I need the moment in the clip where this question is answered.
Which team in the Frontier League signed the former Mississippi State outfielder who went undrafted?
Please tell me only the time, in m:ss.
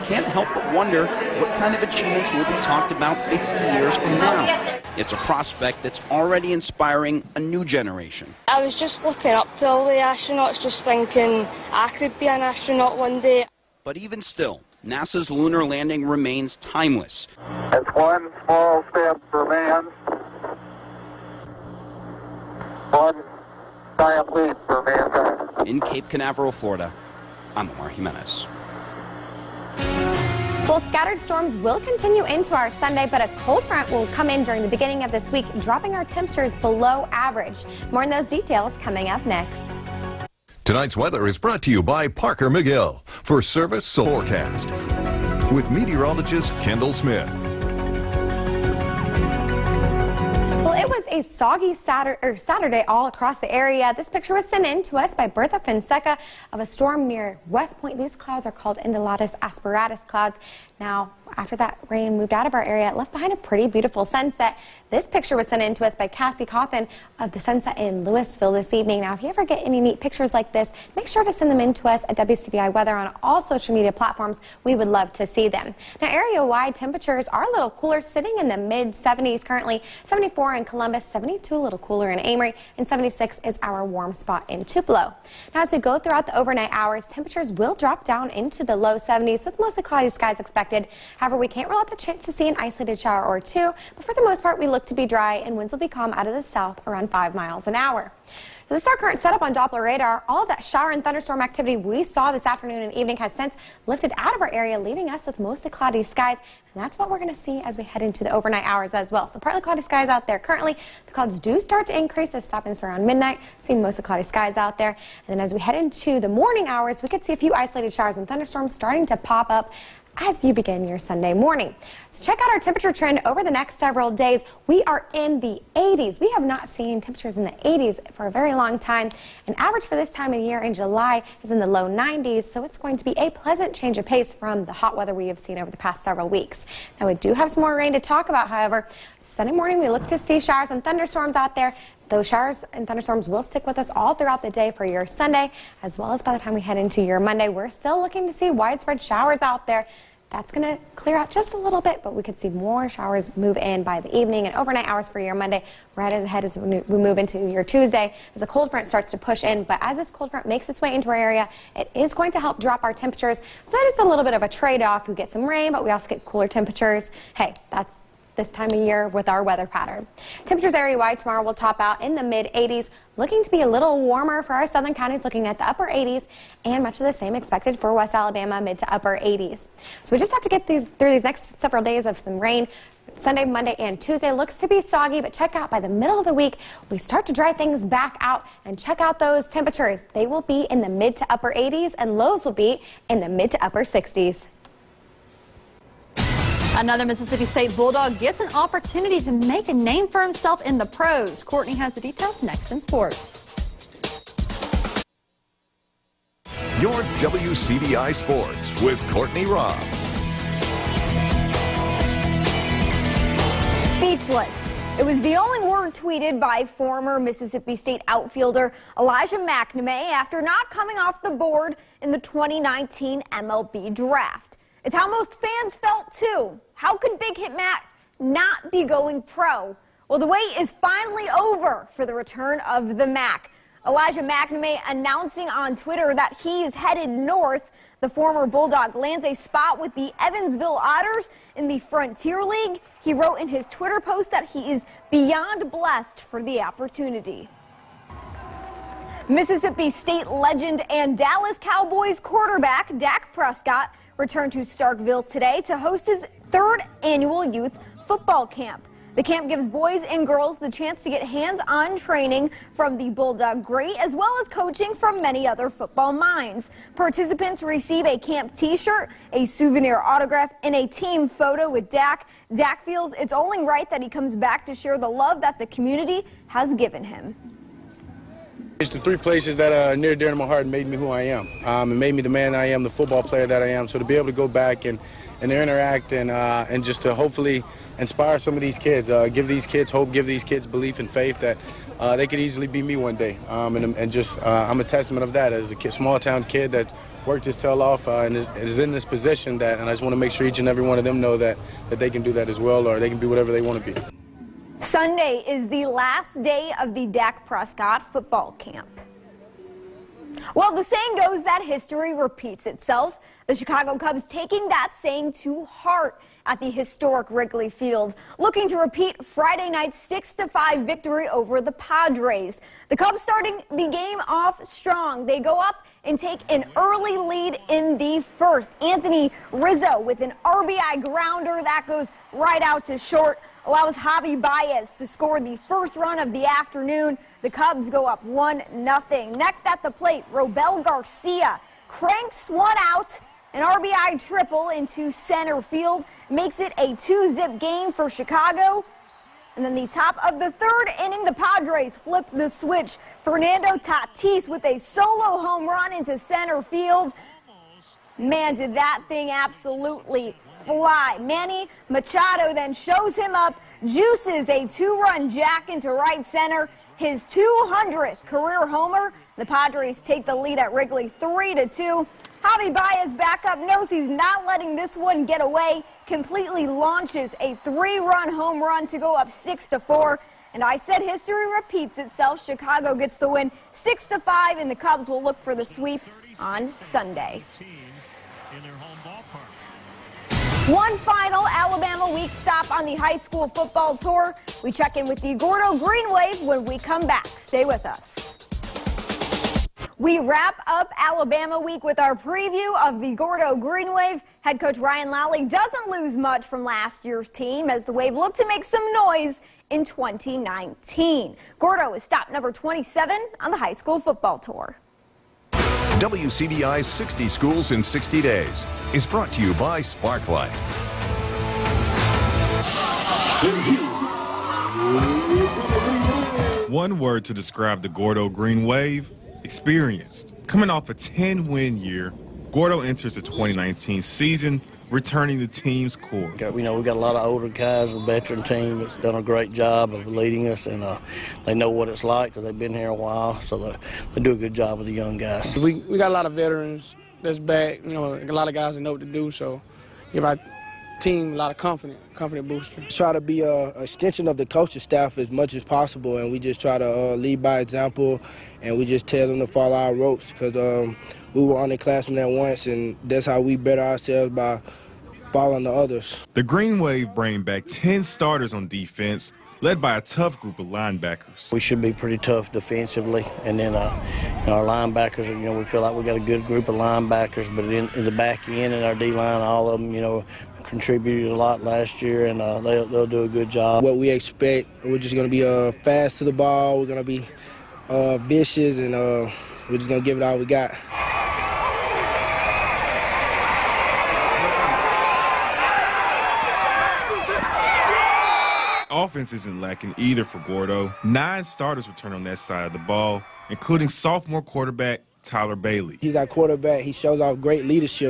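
4:00.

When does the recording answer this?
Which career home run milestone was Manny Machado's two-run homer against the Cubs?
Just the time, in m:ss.
6:07.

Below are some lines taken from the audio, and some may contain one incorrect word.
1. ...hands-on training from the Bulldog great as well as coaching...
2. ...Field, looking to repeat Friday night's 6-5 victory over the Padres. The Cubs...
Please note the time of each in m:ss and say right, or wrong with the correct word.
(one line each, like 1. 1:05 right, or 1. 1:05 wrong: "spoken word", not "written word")
1. 4:21 right
2. 5:17 right.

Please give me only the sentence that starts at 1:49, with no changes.
So partly cloudy skies out there currently.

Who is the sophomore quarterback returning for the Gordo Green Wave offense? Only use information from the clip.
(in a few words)
Tyler Bailey.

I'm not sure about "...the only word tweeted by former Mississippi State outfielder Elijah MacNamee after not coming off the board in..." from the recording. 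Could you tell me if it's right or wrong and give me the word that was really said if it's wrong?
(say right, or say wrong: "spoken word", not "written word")
right.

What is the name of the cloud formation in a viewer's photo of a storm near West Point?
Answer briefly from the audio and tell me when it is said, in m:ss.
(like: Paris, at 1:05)
undulatus asperatus, at 0:58.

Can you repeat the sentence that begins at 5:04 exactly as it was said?
Sunday is the last day of the Dak Prescott football camp.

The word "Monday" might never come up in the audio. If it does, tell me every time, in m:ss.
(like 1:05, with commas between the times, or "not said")
2:27, 2:35, 3:03.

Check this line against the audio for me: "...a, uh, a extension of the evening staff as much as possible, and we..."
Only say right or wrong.
wrong.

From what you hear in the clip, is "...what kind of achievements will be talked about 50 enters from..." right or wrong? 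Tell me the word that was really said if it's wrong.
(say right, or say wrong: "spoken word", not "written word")
wrong: "years", not "enters".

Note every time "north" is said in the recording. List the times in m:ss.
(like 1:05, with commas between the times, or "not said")
3:57.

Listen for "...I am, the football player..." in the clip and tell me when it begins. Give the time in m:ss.
4:42.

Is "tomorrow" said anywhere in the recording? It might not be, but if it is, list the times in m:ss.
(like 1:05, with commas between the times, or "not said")
2:51.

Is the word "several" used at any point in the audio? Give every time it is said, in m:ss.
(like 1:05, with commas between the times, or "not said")
2:03, 2:16, 3:01.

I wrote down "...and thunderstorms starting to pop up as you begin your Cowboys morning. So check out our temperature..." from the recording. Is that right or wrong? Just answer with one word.
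wrong.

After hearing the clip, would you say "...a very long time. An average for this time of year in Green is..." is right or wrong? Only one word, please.
wrong.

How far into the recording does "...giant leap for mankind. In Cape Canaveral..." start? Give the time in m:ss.
0:23.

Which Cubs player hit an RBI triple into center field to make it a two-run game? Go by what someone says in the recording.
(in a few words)
Robel Garcia.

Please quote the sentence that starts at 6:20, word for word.
And I said history repeats itself.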